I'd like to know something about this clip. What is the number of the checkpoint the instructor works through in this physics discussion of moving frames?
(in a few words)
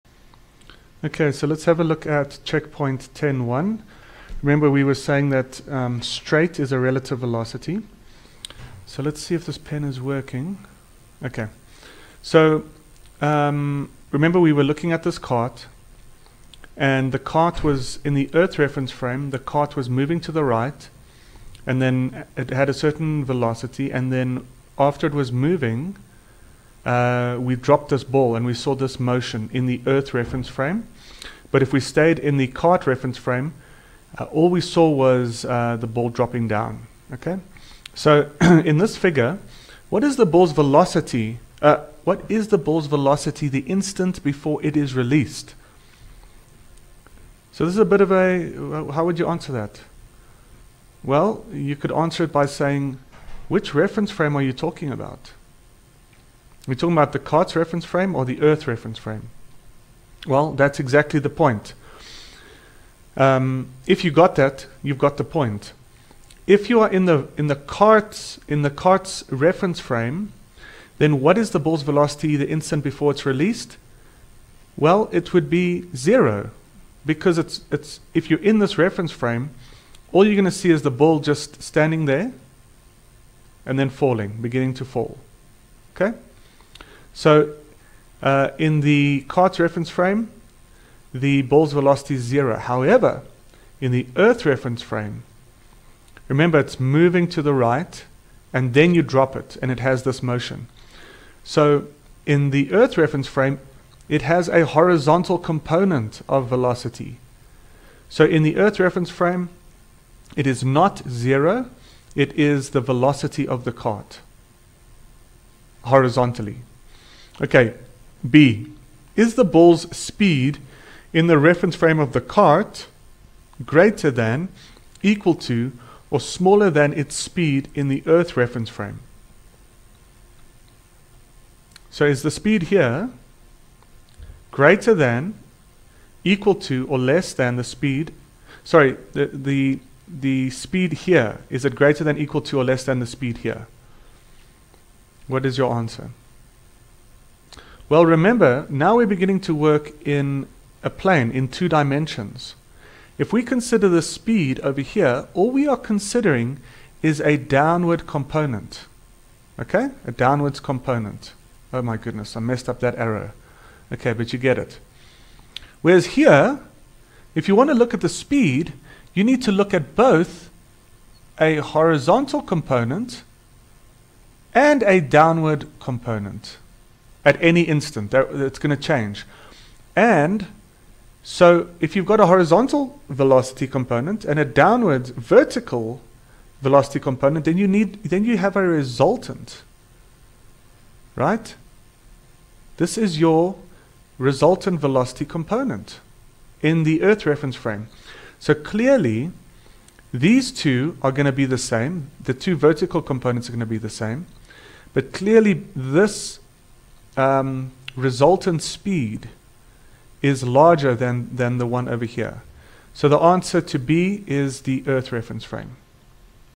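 10.1.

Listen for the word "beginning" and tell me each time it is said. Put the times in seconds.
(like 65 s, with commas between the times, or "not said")
84 s, 149 s.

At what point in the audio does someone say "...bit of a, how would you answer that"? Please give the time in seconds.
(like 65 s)
47 s.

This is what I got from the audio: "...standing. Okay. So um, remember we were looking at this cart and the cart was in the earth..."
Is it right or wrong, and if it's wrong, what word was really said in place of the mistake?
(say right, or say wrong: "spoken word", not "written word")
wrong: "working", not "standing".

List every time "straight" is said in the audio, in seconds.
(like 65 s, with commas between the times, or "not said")
6 s.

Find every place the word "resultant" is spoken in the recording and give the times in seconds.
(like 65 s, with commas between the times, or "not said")
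188 s, 194 s, 207 s.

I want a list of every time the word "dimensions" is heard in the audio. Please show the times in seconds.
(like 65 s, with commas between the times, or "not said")
151 s.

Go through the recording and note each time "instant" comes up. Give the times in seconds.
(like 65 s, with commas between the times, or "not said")
43 s, 72 s, 177 s.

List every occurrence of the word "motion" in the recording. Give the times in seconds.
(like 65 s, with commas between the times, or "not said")
28 s, 100 s.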